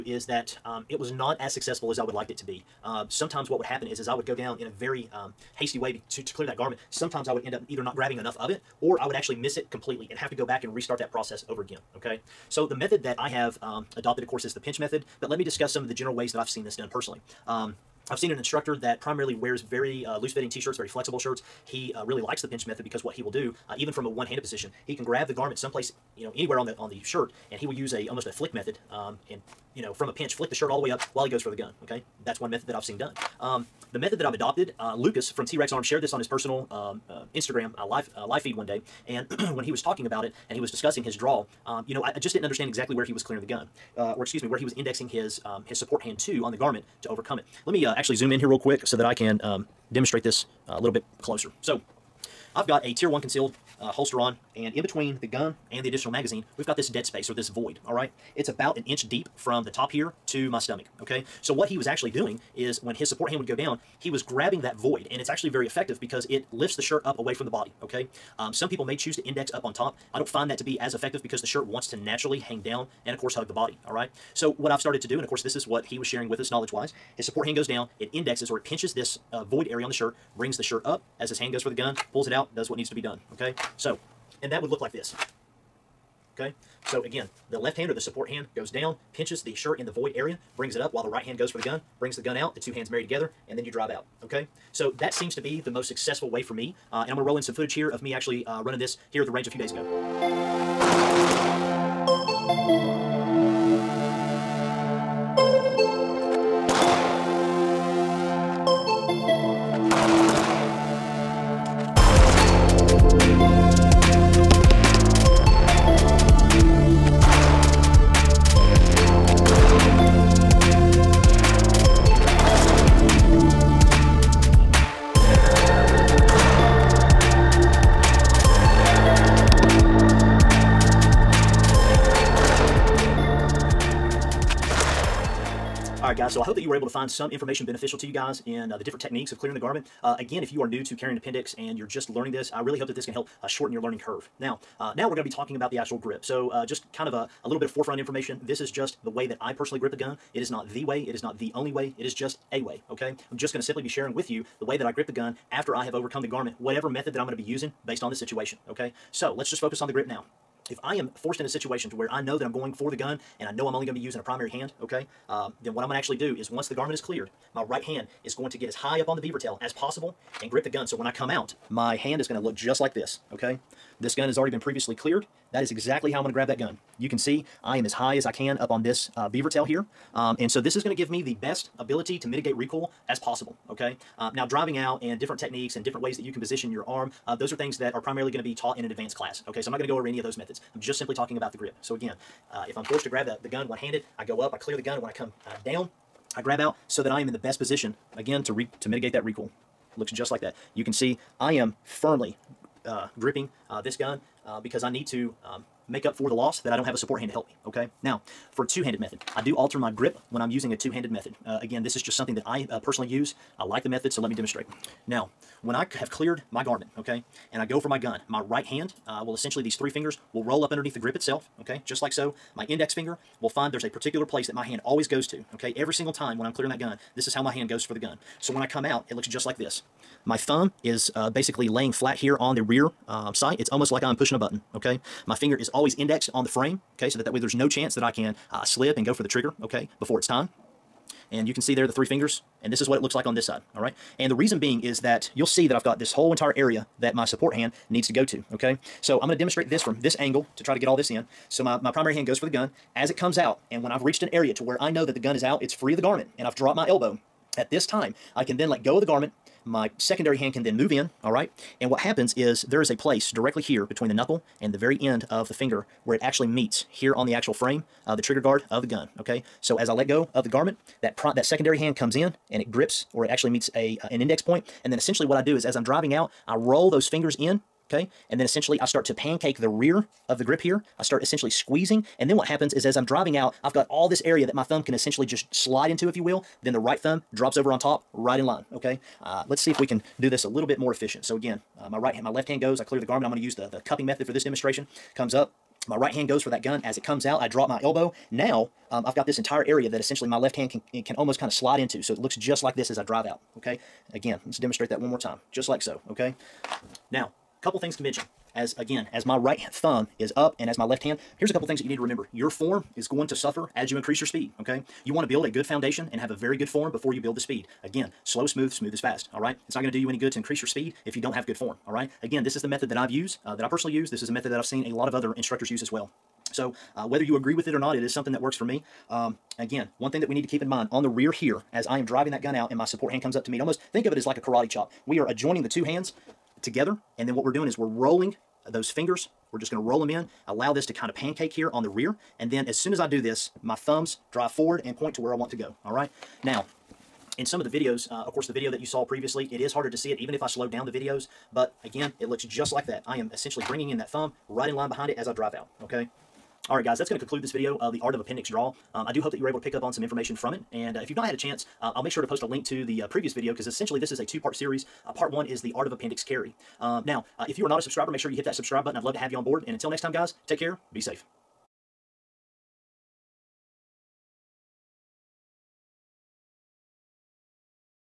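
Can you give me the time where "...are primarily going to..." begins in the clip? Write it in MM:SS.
03:07.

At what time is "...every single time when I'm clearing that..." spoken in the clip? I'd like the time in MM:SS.
03:45.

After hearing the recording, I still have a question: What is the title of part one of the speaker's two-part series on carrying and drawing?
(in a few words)
The Art of Appendix Carry.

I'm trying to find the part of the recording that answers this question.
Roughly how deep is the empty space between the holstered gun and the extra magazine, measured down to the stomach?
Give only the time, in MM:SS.
00:58.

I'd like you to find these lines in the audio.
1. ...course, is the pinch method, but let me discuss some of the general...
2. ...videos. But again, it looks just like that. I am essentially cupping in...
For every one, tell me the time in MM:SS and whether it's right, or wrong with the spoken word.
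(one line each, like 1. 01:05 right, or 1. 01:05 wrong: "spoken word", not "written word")
1. 00:14 right
2. 05:50 wrong: "bringing", not "cupping".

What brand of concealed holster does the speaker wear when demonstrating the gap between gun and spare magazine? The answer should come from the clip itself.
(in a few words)
Tier 1.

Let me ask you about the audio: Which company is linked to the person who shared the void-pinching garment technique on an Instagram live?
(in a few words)
T Rex Arm.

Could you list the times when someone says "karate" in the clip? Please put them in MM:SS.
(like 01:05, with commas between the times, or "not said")
05:34.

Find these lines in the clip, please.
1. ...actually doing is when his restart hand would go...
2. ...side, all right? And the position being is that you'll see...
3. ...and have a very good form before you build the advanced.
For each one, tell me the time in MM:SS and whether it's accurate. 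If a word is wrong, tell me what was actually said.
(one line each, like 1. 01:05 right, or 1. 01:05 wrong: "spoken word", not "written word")
1. 01:01 wrong: "support", not "restart"
2. 04:03 wrong: "reason", not "position"
3. 05:16 wrong: "speed", not "advanced".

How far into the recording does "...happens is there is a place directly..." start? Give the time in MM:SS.
04:21.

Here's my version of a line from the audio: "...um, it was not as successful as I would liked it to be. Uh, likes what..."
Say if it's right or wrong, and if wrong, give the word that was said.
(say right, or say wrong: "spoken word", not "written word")
wrong: "sometimes", not "likes".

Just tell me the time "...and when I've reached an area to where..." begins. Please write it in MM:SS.
04:13.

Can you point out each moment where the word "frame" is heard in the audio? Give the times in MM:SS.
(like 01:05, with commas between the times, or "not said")
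03:56, 04:27.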